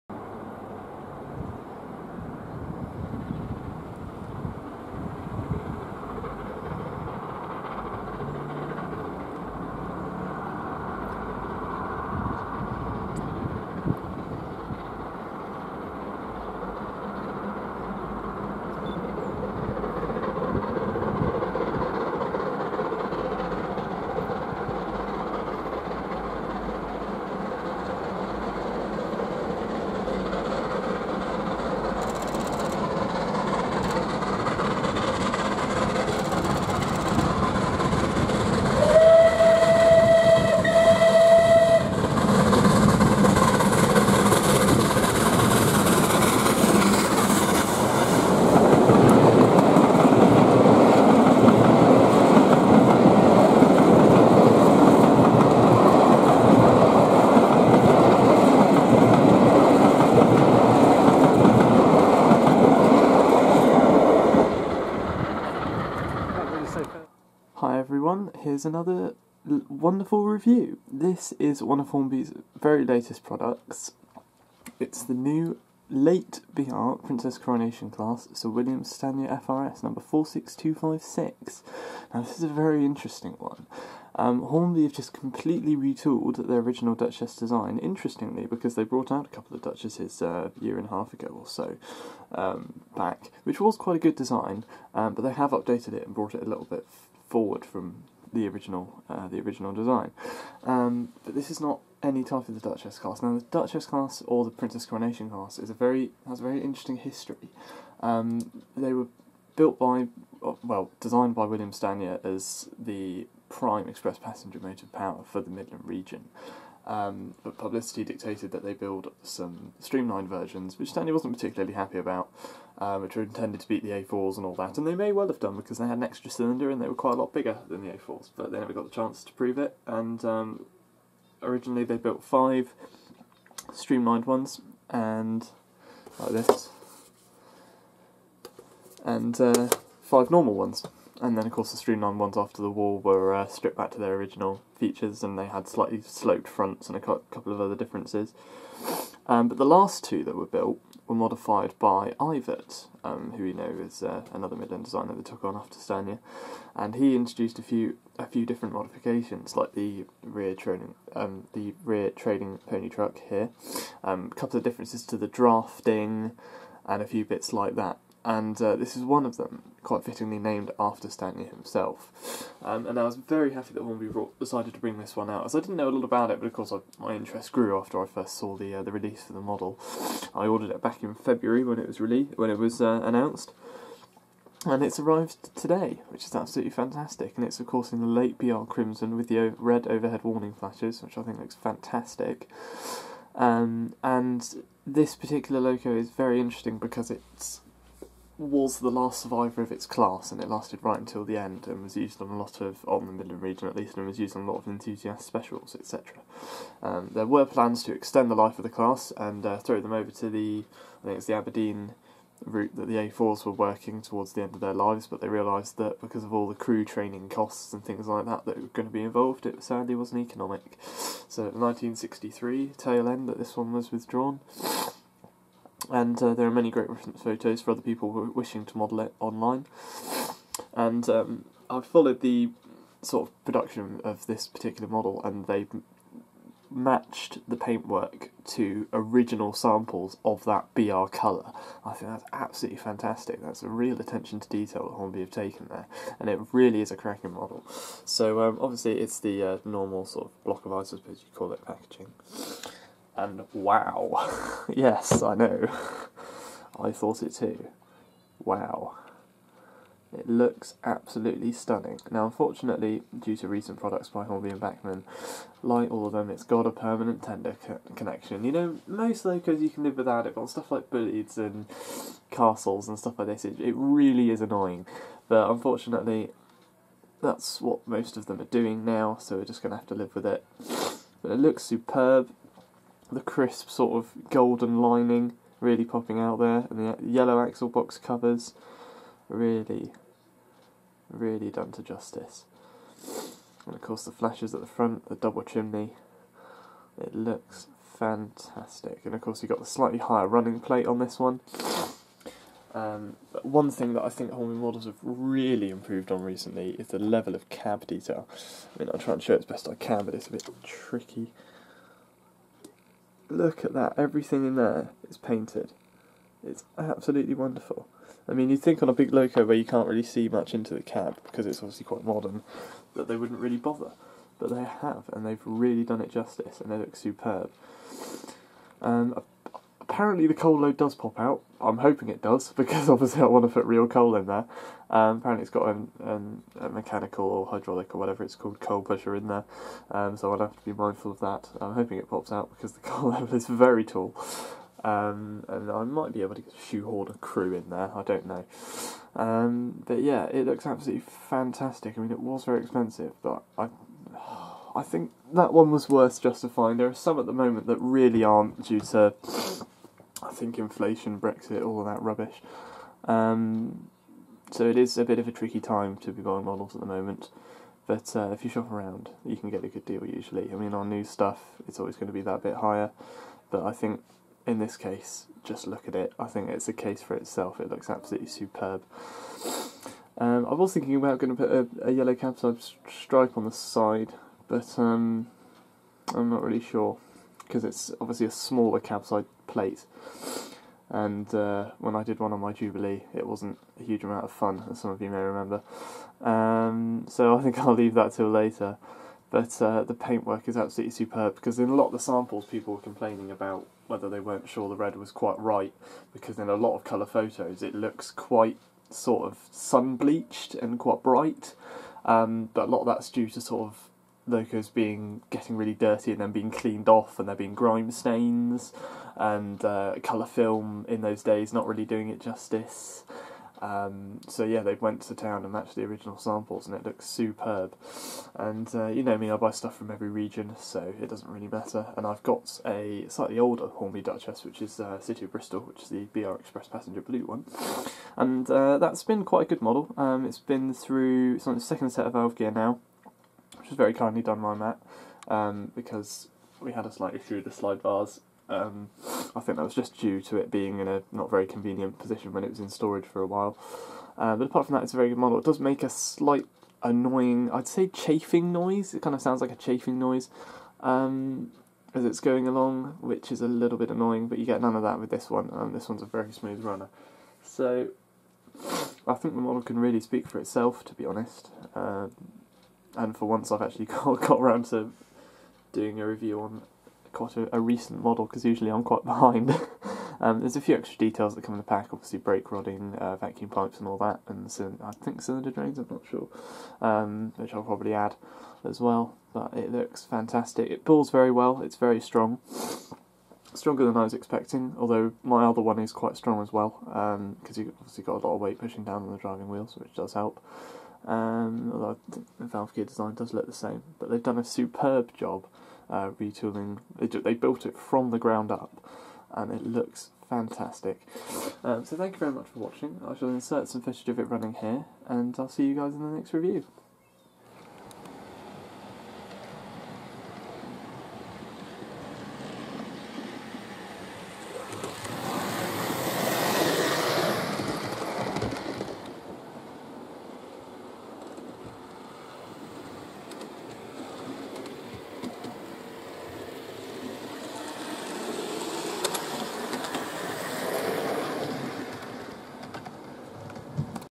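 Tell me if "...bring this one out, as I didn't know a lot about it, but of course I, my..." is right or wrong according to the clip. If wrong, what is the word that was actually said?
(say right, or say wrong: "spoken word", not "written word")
right.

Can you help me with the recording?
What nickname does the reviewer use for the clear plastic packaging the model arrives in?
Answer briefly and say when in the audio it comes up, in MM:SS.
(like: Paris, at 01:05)
block of ice, at 04:10.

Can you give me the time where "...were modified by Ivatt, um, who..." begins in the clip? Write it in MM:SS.
02:31.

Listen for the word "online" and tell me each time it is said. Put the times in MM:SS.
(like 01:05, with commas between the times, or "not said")
03:49.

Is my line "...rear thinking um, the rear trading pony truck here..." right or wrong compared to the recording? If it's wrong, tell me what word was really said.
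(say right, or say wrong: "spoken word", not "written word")
wrong: "training", not "thinking".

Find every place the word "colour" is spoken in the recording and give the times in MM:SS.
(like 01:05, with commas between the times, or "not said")
04:01, 06:46, 07:00.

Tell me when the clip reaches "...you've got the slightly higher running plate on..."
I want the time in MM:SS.
04:59.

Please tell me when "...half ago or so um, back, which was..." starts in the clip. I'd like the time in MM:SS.
01:30.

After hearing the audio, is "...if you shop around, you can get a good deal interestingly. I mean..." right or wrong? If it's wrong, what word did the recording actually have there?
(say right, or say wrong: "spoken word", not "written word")
wrong: "usually", not "interestingly".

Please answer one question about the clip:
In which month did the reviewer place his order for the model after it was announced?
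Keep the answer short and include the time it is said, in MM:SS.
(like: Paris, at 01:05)
February, at 03:01.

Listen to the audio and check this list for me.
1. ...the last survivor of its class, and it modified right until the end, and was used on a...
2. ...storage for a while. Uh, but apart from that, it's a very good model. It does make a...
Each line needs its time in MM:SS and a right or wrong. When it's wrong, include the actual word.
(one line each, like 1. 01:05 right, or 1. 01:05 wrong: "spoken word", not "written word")
1. 03:18 wrong: "lasted", not "modified"
2. 07:32 right.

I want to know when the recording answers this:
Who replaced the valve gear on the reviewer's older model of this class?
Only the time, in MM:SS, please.
07:24.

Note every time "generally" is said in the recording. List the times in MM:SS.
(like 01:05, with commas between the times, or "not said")
not said.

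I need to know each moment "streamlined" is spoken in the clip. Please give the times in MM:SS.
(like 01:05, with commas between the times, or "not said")
01:59, 02:13, 02:21.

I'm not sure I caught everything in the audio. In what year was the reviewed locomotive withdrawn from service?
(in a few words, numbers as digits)
1963.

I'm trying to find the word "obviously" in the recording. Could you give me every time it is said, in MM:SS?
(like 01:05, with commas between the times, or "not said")
04:08, 05:21, 05:32, 06:27, 08:01, 08:17.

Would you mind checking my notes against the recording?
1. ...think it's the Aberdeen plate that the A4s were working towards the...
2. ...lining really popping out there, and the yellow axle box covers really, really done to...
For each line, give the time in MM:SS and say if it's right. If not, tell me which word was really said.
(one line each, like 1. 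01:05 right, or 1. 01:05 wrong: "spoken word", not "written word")
1. 03:31 wrong: "route", not "plate"
2. 04:44 right.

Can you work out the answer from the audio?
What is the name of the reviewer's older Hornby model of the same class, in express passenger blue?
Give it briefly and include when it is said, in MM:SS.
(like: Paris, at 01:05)
City of Bristol, at 07:14.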